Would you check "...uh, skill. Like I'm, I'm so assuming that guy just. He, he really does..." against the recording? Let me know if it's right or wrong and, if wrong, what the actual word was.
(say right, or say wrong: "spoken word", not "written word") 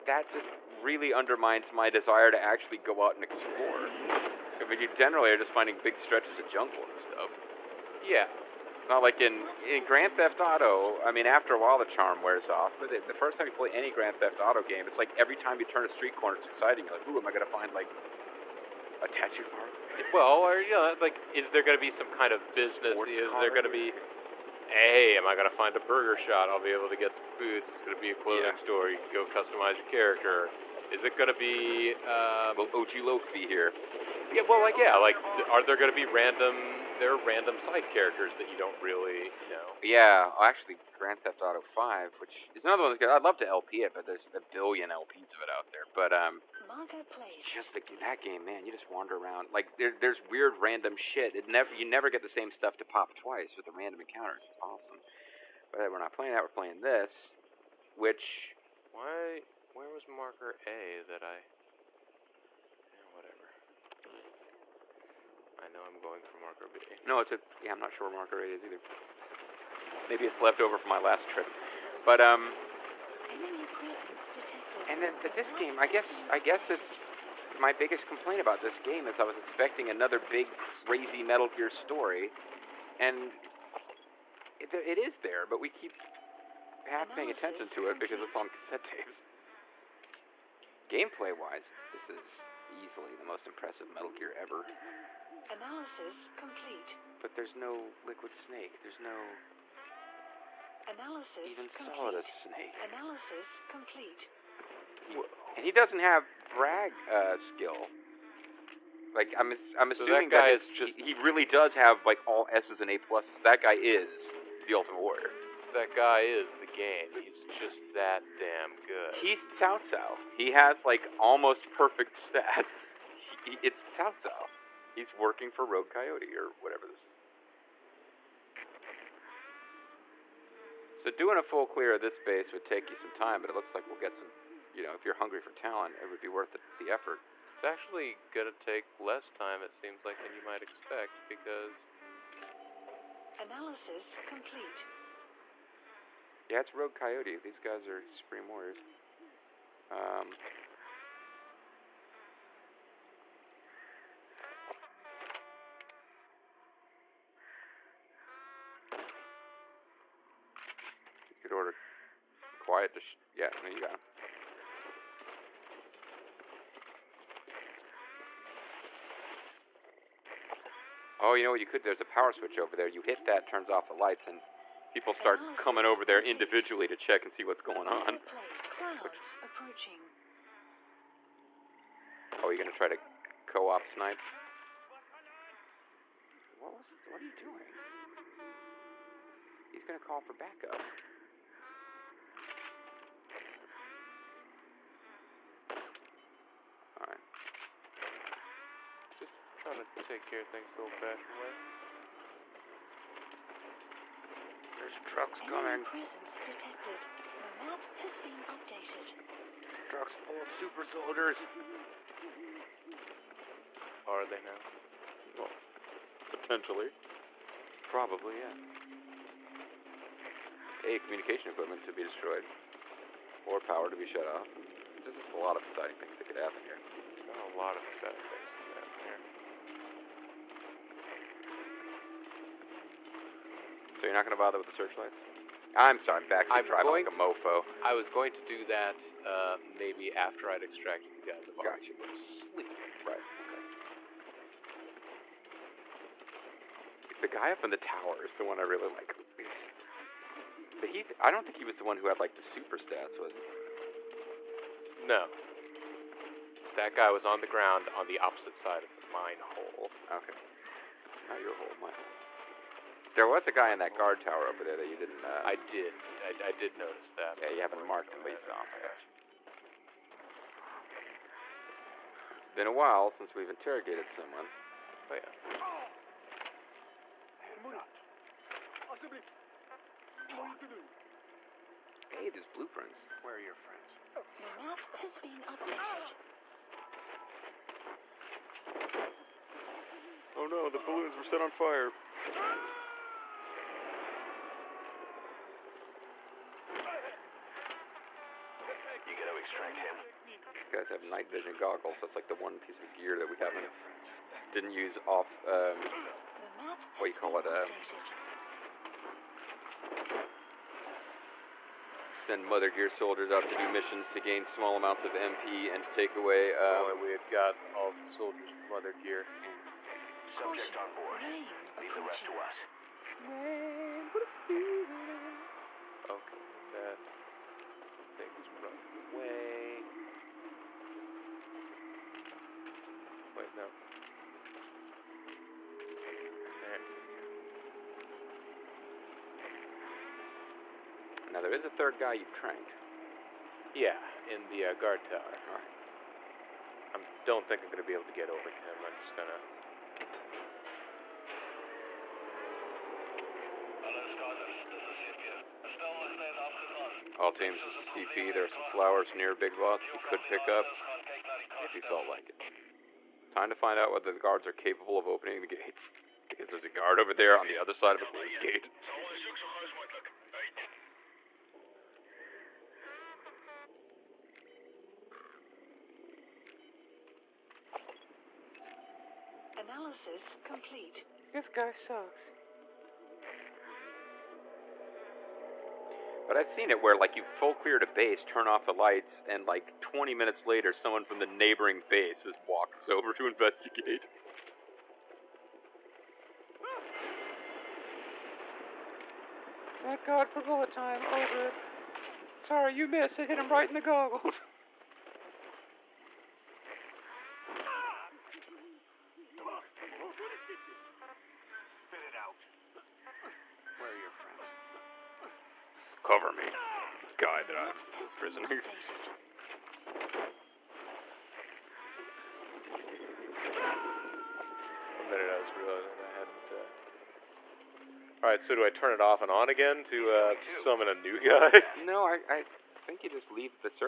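right.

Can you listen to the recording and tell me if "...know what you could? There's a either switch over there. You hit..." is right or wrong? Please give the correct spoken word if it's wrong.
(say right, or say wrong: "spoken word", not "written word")
wrong: "power", not "either".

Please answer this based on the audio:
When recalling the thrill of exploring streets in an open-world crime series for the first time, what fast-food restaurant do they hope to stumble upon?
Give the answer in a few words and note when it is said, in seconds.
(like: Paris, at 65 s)
Burger Shot, at 25 s.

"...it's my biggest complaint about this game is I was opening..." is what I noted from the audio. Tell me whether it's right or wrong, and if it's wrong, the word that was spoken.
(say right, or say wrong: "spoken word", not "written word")
wrong: "expecting", not "opening".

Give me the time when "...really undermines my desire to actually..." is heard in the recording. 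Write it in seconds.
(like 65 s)
0 s.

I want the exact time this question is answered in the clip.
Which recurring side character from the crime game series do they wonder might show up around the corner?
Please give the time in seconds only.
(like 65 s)
32 s.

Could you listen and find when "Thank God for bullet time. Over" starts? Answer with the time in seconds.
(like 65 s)
399 s.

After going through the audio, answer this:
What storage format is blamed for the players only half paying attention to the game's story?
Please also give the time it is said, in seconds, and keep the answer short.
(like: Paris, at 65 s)
cassette tapes, at 88 s.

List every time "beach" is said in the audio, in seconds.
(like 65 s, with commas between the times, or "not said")
not said.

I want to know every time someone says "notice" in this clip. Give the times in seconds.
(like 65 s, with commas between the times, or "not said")
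266 s.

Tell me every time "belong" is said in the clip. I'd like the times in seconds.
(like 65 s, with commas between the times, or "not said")
not said.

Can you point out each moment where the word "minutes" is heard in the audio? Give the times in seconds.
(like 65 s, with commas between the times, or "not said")
390 s, 425 s.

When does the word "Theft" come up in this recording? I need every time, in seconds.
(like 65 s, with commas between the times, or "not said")
10 s, 14 s, 41 s.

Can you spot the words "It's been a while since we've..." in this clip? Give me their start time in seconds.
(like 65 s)
272 s.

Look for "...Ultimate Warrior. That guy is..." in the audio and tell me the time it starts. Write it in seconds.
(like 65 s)
114 s.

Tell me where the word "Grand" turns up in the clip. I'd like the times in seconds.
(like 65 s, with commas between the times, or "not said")
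9 s, 13 s, 40 s.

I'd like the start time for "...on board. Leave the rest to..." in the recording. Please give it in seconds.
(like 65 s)
320 s.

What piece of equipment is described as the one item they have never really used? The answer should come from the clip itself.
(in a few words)
night vision goggles.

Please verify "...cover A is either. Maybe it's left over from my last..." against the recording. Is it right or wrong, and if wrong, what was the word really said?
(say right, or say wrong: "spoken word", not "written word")
wrong: "marker", not "cover".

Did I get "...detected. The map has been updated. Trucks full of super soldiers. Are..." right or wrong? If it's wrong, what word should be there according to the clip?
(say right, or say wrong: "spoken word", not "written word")
right.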